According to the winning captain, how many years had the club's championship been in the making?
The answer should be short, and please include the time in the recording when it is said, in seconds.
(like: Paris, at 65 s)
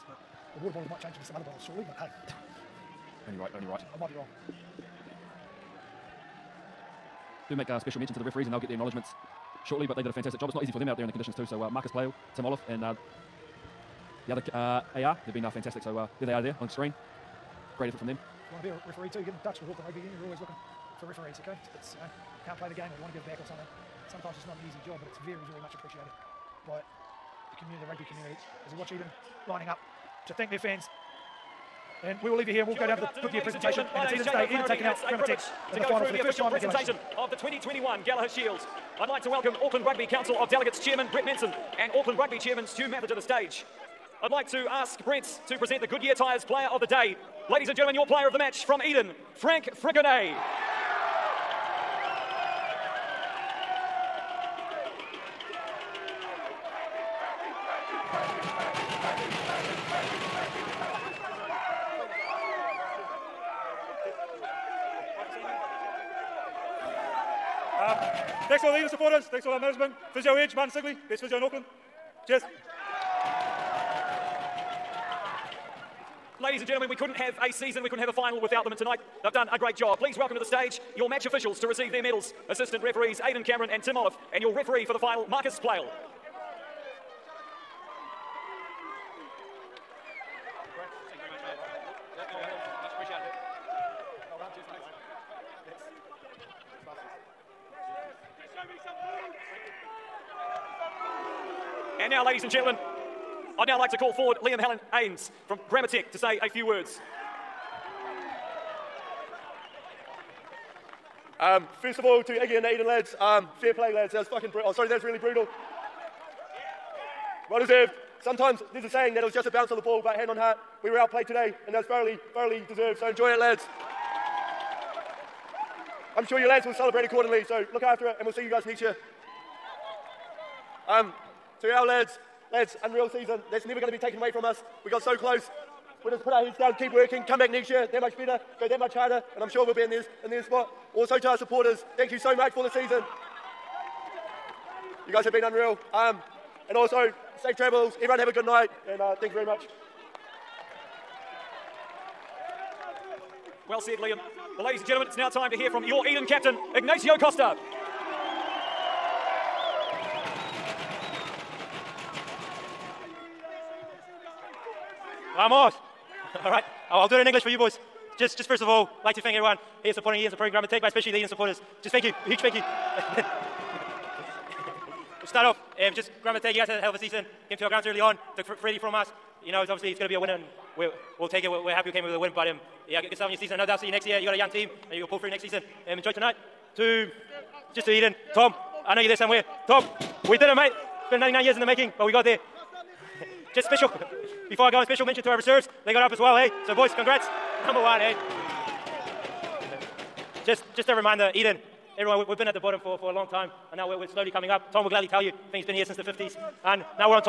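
99, at 191 s.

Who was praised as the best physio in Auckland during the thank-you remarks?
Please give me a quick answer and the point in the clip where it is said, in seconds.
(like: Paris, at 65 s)
Martin Sigley, at 70 s.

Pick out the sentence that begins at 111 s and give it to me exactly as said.
Um, first of all, to Iggy and the Eden lads, um, fair play, lads.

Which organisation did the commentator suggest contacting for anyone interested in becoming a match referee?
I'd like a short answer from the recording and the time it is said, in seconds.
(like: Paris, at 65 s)
Auckland Rugby Union, at 19 s.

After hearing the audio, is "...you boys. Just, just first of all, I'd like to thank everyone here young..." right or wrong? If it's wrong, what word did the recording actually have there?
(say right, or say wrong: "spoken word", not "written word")
wrong: "supporting", not "young".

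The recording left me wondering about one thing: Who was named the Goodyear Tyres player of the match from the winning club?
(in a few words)
Frank Frickenet.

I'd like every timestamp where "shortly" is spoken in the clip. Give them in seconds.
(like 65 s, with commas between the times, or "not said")
1 s, 9 s.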